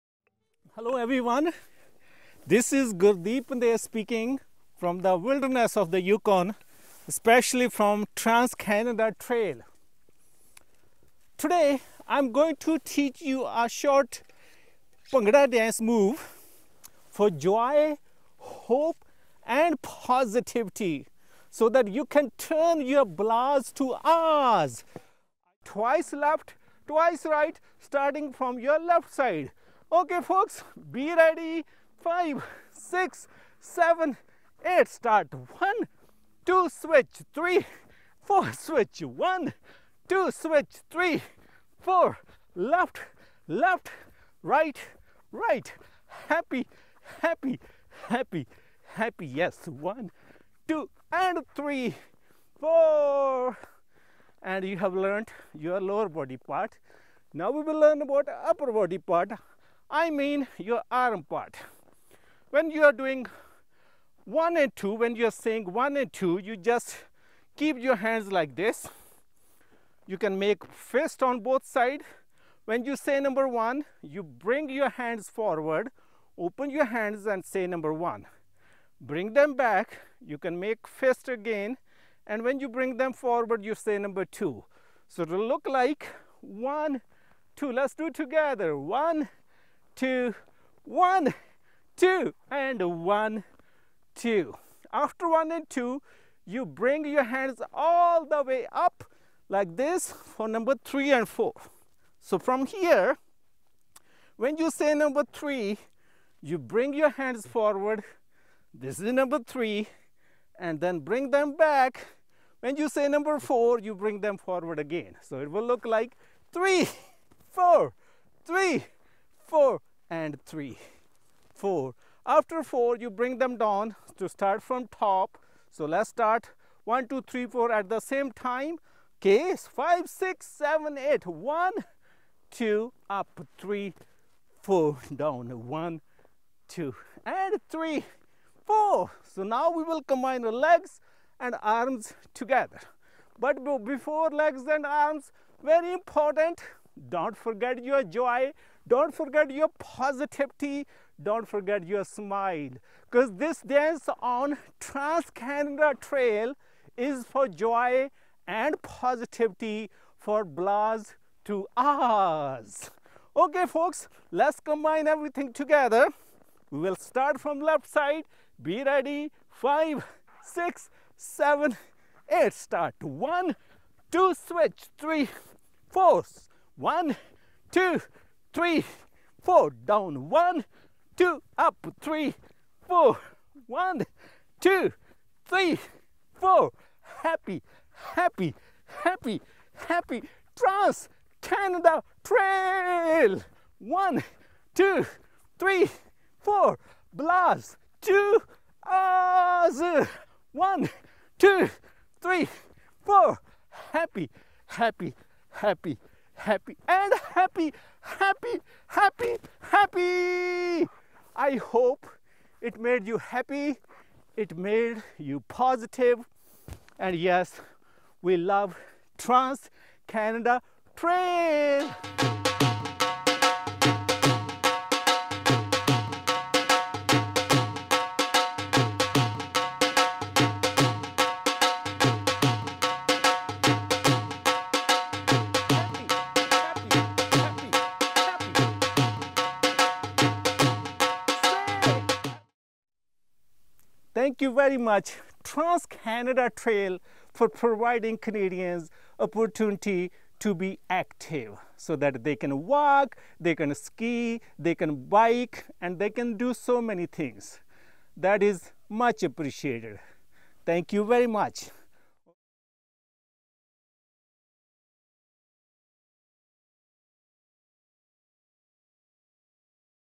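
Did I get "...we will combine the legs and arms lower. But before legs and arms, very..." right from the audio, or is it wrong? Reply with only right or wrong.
wrong.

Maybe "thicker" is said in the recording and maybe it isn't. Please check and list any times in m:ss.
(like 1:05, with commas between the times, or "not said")
not said.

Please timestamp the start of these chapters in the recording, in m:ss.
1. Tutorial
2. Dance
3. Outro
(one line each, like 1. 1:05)
1. 0:25
2. 3:41
3. 4:03.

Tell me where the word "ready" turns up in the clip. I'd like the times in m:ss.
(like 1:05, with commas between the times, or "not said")
0:31, 2:48.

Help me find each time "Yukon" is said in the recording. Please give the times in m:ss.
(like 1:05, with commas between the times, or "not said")
0:06.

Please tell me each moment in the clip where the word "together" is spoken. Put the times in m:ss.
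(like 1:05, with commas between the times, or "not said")
1:28, 2:22, 2:45.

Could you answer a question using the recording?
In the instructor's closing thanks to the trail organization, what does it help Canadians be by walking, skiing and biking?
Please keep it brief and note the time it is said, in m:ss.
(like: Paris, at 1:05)
Active, at 4:10.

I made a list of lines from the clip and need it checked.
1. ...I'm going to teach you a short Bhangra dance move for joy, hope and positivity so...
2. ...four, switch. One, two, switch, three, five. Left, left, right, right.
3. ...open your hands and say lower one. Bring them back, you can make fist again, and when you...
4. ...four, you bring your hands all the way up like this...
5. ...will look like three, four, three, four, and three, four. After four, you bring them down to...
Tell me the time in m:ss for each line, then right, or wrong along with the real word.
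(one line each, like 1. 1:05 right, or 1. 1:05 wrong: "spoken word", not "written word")
1. 0:12 right
2. 0:38 wrong: "four", not "five"
3. 1:16 wrong: "number", not "lower"
4. 1:35 wrong: "two", not "four"
5. 1:55 right.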